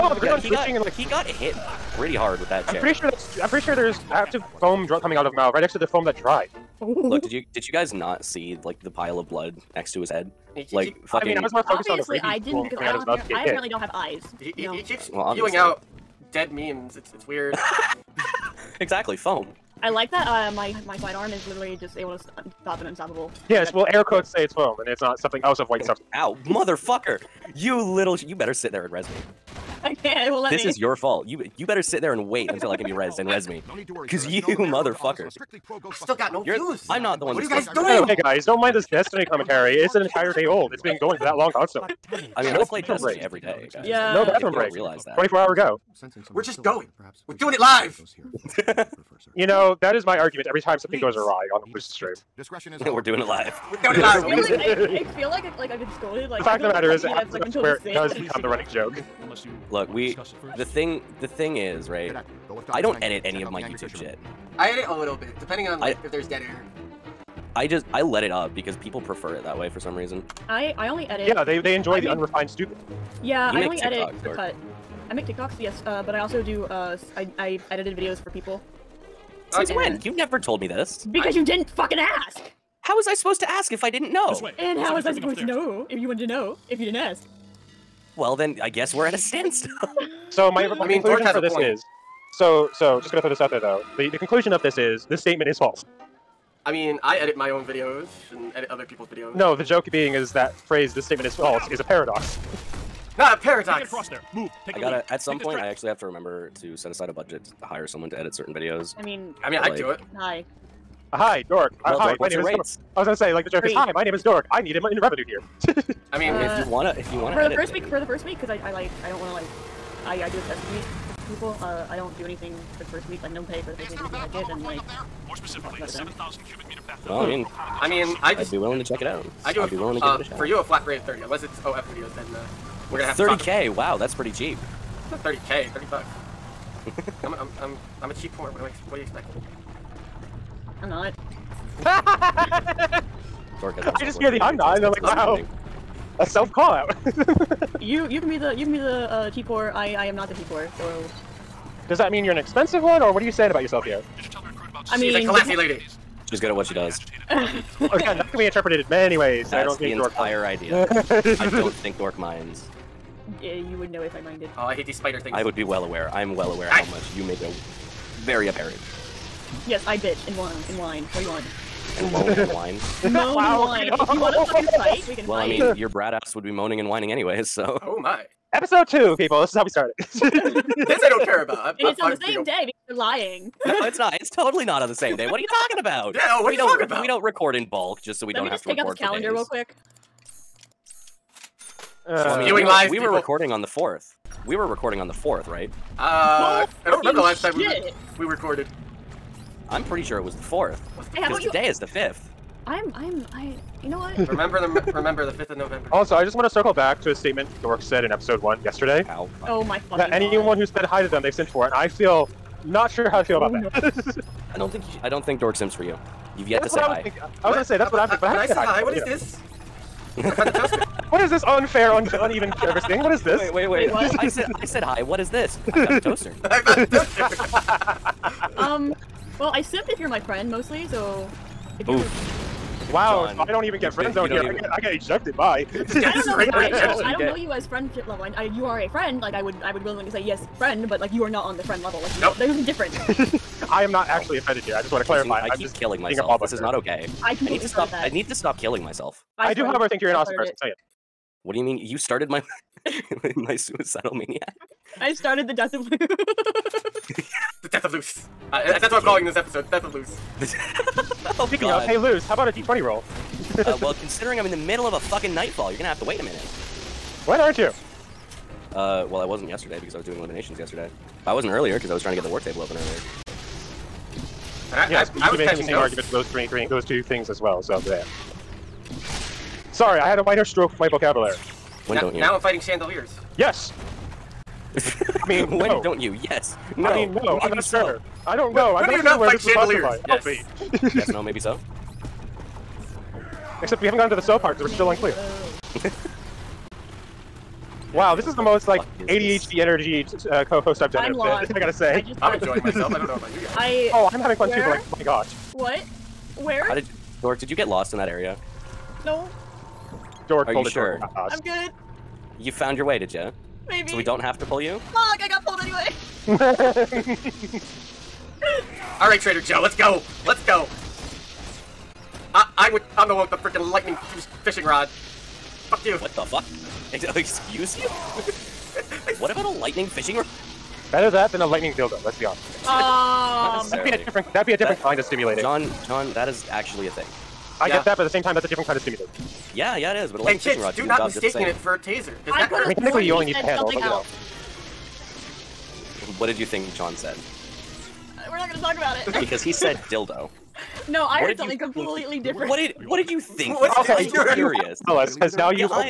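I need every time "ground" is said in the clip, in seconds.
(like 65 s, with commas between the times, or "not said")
0 s.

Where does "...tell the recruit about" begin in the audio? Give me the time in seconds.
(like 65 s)
154 s.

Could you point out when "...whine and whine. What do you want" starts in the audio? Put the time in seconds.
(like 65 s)
170 s.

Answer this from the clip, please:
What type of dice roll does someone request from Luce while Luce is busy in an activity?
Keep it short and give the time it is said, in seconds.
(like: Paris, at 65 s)
D20, at 262 s.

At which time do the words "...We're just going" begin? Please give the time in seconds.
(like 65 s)
46 s.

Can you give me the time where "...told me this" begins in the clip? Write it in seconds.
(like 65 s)
80 s.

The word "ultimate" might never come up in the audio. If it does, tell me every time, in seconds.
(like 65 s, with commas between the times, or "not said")
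not said.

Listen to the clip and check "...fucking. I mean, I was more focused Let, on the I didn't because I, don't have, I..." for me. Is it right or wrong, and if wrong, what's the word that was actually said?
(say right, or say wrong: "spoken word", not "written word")
wrong: "Obviously", not "Let".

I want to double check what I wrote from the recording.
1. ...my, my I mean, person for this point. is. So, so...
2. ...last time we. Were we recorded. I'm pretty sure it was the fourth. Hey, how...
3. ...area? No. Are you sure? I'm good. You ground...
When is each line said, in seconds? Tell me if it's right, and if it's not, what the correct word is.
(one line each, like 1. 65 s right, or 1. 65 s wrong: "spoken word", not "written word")
1. 90 s wrong: "conclusion", not "person"
2. 197 s right
3. 308 s wrong: "found", not "ground".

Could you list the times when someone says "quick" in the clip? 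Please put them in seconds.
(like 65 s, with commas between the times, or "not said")
189 s.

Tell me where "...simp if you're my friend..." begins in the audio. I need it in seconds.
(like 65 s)
229 s.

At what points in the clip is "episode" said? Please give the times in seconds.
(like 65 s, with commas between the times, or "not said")
178 s, 208 s, 259 s.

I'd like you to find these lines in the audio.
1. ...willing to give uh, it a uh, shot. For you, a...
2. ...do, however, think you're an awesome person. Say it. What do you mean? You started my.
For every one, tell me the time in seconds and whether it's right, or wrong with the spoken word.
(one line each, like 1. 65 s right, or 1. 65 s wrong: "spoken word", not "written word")
1. 129 s right
2. 249 s right.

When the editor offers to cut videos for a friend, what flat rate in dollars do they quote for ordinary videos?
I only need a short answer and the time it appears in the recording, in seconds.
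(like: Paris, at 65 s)
30 bucks, at 135 s.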